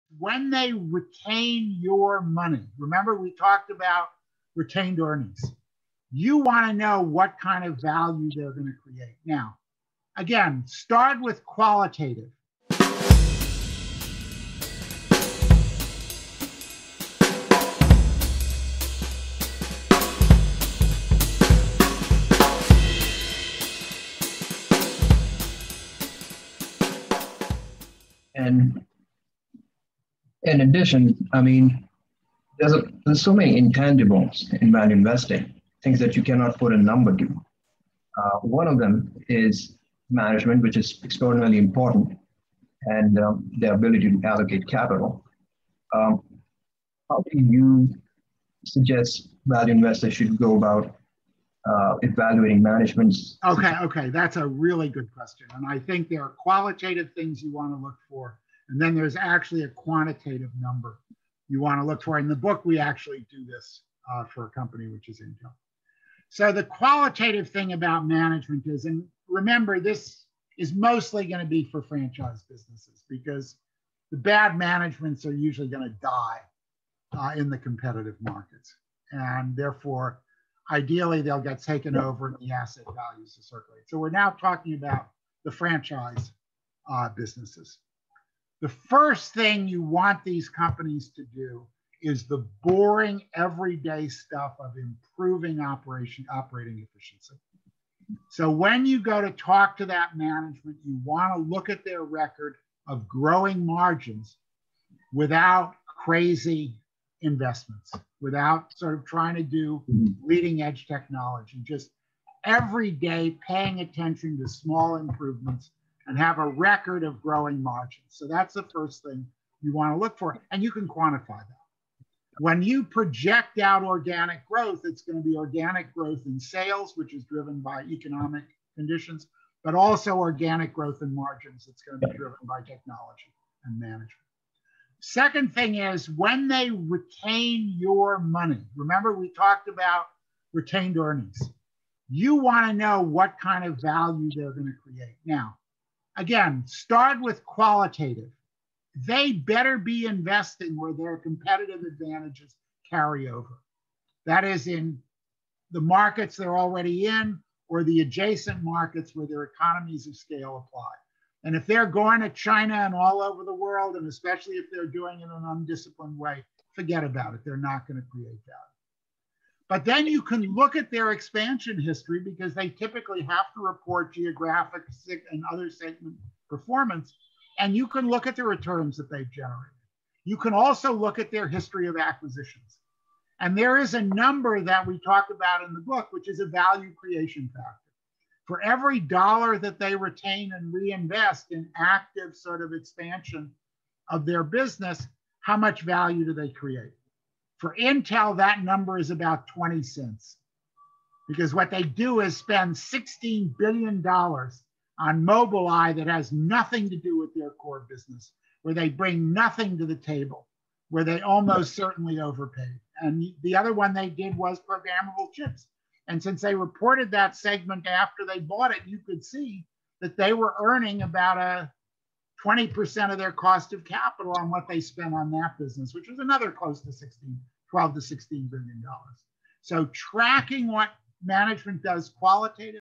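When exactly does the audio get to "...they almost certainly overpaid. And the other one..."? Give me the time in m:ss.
3:31.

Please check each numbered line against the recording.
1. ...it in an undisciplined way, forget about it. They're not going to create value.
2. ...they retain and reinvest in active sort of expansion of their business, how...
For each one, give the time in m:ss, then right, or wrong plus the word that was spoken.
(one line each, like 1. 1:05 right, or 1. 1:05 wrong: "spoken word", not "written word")
1. 2:45 right
2. 3:09 right.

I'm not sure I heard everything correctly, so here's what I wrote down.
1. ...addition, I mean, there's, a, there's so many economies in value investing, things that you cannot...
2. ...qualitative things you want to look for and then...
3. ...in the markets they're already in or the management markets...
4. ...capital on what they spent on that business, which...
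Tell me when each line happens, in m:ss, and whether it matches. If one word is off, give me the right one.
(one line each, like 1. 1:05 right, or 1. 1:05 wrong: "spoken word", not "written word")
1. 0:30 wrong: "intangibles", not "economies"
2. 0:56 right
3. 2:34 wrong: "adjacent", not "management"
4. 3:43 right.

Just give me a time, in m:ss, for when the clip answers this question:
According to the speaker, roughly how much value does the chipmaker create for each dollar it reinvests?
3:19.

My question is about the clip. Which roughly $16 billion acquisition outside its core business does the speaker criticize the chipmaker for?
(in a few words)
Mobileye.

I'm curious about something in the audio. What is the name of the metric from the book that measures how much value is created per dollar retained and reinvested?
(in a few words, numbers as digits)
value creation factor.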